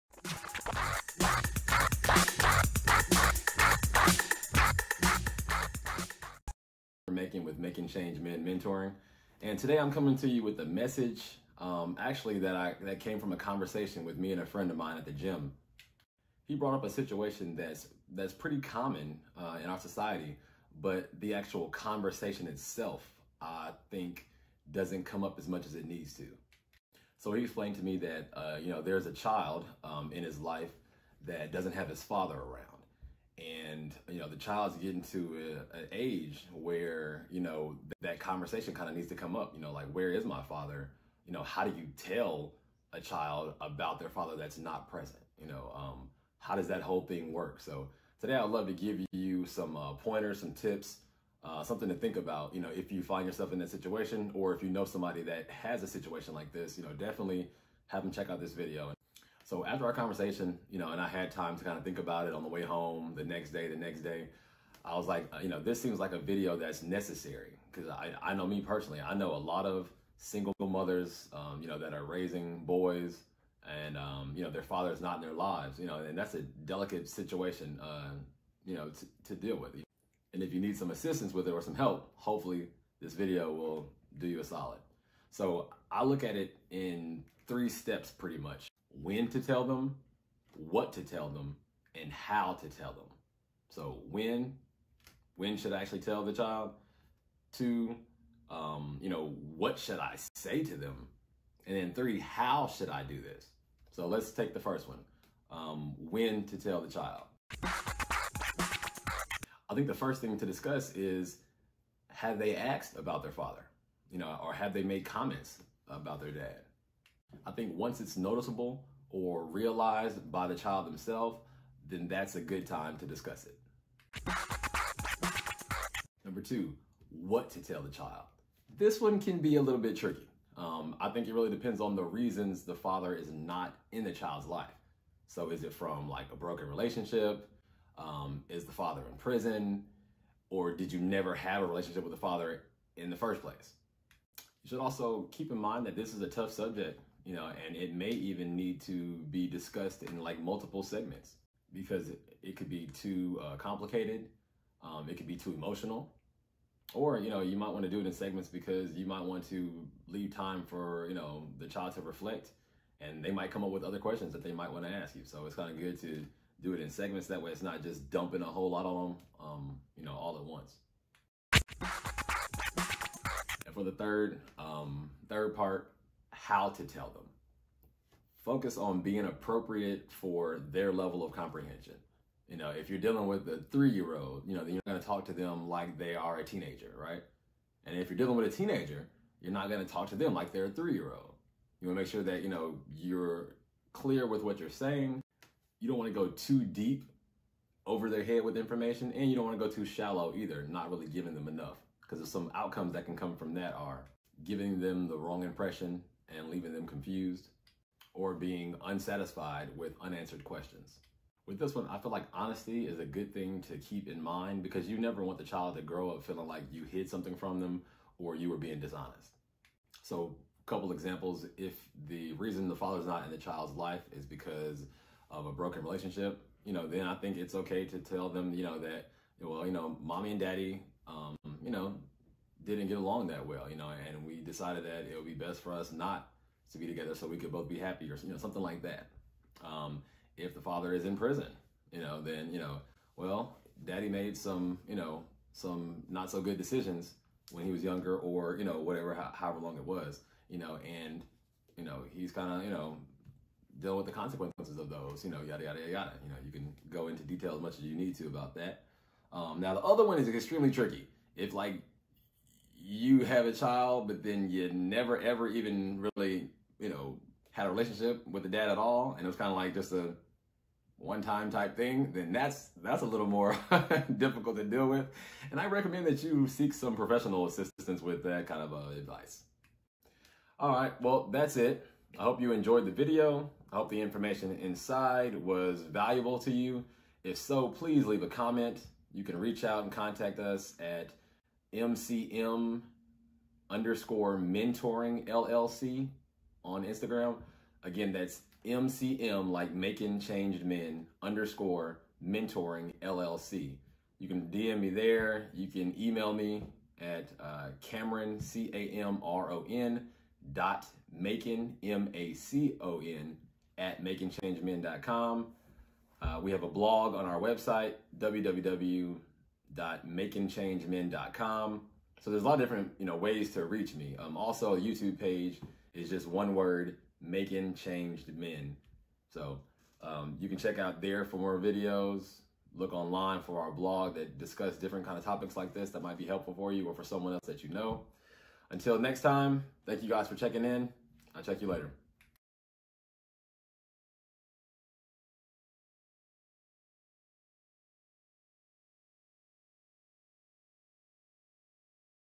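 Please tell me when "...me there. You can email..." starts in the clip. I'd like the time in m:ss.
5:04.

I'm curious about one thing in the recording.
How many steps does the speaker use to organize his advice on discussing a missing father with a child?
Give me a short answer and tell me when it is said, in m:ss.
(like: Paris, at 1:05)
3, at 1:27.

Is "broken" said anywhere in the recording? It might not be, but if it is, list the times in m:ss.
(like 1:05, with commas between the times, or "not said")
2:16, 3:45.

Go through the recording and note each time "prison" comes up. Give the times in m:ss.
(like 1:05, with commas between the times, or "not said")
2:19, 4:01.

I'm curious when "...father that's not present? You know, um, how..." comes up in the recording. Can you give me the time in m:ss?
0:44.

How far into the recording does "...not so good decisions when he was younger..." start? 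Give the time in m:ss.
4:06.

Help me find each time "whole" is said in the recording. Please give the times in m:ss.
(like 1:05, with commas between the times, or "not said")
0:46, 2:48.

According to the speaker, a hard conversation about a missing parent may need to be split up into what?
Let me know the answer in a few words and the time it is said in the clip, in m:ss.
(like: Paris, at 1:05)
Multiple segments, at 2:30.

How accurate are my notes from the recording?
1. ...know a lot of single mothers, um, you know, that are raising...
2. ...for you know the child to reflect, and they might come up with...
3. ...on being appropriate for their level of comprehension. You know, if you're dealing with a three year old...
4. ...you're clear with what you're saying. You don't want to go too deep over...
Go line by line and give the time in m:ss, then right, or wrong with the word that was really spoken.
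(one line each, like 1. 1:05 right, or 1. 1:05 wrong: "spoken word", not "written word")
1. 1:09 right
2. 2:40 right
3. 2:58 right
4. 3:12 right.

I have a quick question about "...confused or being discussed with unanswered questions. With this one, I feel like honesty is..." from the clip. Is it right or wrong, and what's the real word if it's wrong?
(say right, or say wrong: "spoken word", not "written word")
wrong: "unsatisfied", not "discussed".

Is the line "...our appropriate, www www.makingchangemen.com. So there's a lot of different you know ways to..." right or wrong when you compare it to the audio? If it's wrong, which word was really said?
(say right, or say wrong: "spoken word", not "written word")
wrong: "website", not "appropriate".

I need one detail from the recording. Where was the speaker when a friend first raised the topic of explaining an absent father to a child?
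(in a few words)
The gym.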